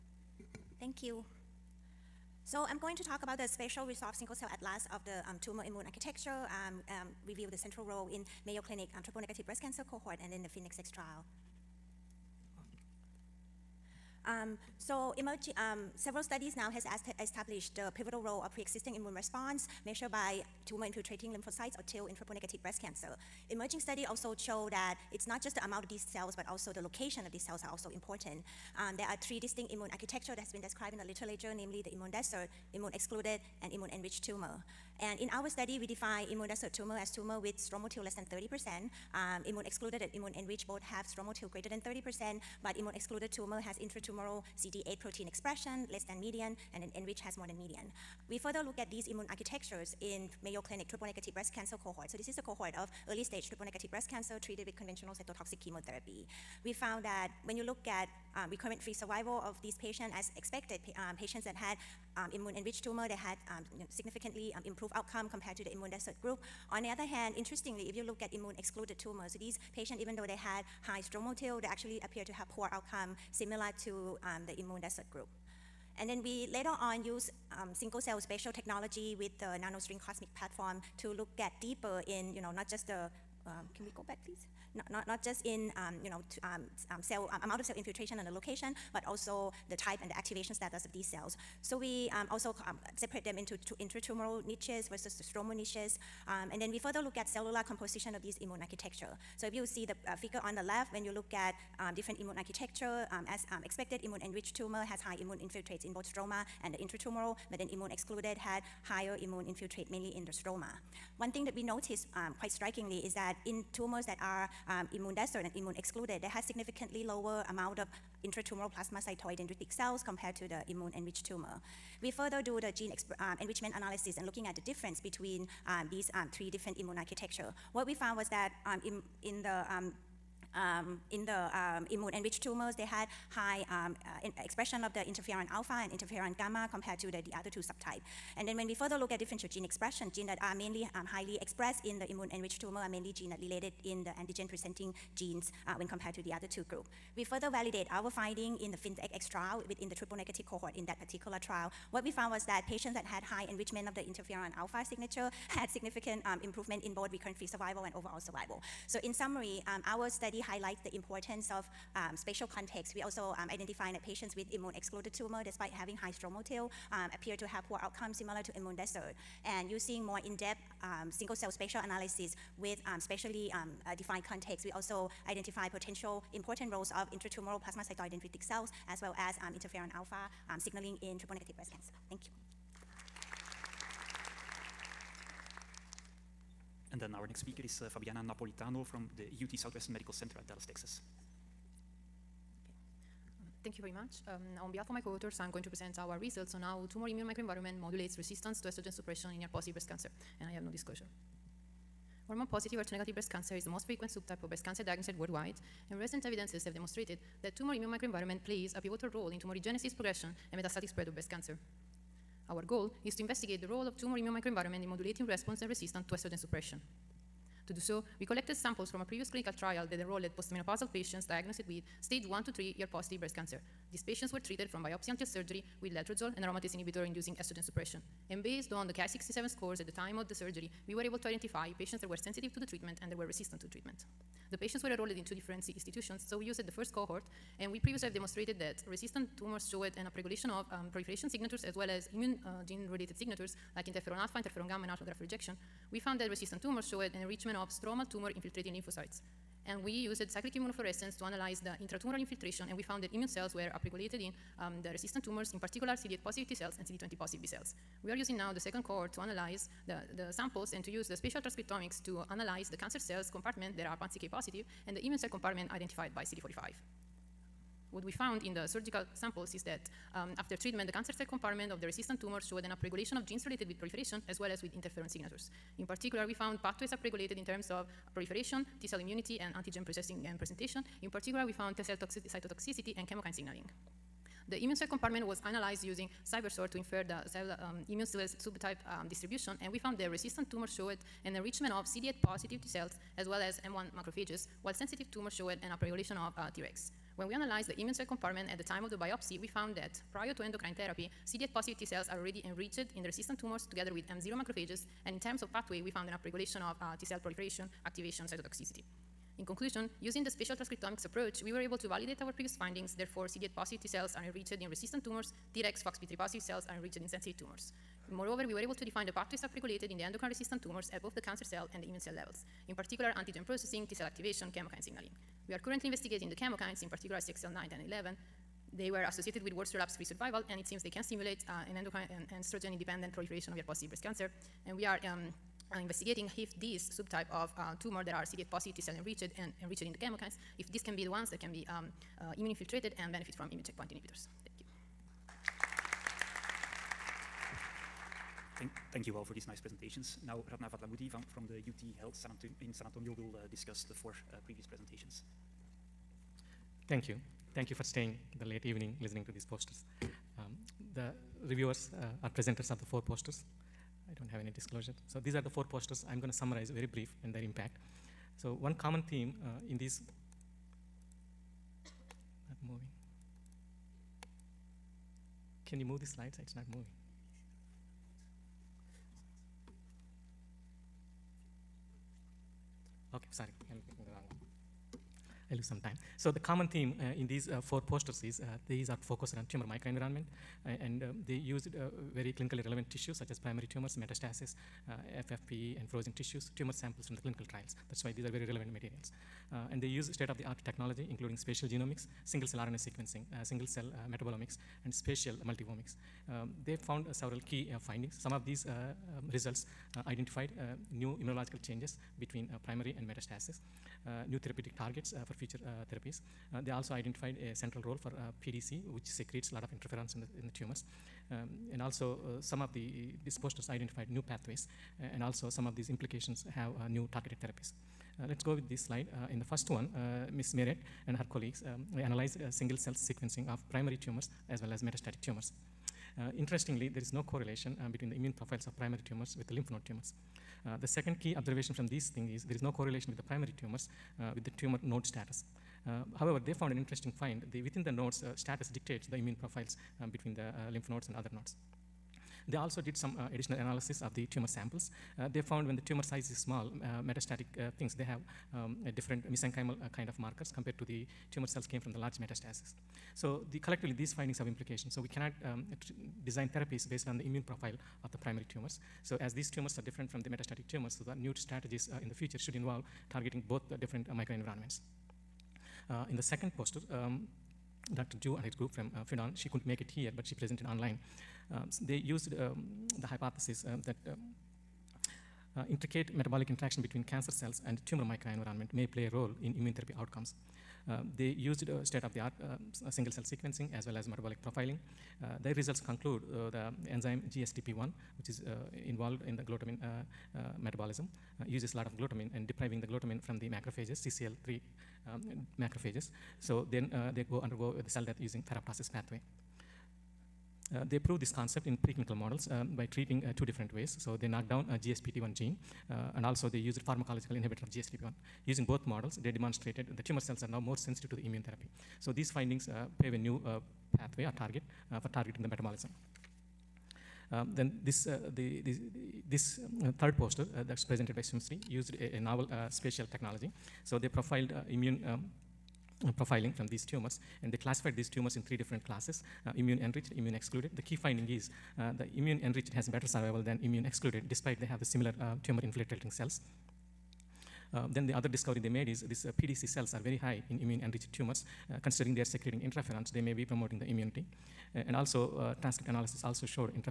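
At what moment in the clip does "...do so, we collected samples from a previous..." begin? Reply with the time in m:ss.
3:37.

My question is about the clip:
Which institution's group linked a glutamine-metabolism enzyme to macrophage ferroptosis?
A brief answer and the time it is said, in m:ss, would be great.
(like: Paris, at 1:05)
Fudan, at 7:59.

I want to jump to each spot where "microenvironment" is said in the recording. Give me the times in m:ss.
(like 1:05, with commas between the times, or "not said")
3:17, 3:27, 3:34, 6:29, 7:54, 8:08.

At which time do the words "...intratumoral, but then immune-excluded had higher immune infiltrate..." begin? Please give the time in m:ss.
1:46.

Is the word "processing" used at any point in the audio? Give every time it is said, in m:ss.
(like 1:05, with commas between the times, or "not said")
4:39, 5:23.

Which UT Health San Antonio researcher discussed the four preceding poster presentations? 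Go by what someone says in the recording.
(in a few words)
Ratna Vadlamudi.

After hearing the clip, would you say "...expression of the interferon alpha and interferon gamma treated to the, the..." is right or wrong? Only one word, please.
wrong.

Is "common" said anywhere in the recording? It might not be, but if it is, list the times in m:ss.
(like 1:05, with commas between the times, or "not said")
6:08, 6:26.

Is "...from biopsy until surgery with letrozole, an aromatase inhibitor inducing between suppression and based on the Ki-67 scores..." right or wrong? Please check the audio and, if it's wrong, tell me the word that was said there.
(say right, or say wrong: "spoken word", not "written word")
wrong: "estrogen", not "between".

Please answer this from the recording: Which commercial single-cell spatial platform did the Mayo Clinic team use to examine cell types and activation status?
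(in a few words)
NanoString CosMx.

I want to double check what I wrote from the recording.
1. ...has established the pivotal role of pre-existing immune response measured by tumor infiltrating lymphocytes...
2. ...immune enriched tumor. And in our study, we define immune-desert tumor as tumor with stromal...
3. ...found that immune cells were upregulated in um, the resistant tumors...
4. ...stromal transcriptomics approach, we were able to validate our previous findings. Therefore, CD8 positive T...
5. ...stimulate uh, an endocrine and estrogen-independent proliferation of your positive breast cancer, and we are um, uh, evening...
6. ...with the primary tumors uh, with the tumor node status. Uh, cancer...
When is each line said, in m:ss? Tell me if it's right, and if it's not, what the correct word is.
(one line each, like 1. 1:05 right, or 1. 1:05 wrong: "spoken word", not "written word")
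1. 0:16 right
2. 0:33 right
3. 4:12 right
4. 5:10 wrong: "spatial", not "stromal"
5. 5:31 wrong: "investigating", not "evening"
6. 7:23 wrong: "however", not "cancer".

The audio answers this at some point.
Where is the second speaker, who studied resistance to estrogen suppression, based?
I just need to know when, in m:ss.
3:09.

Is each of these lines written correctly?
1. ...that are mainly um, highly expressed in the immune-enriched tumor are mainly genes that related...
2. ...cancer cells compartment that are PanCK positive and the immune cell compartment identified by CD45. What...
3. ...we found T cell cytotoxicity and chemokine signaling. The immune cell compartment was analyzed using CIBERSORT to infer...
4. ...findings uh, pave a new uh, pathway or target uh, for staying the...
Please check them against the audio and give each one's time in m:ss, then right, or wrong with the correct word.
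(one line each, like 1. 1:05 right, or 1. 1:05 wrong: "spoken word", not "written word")
1. 2:20 right
2. 4:22 right
3. 4:41 right
4. 8:42 wrong: "targeting", not "staying".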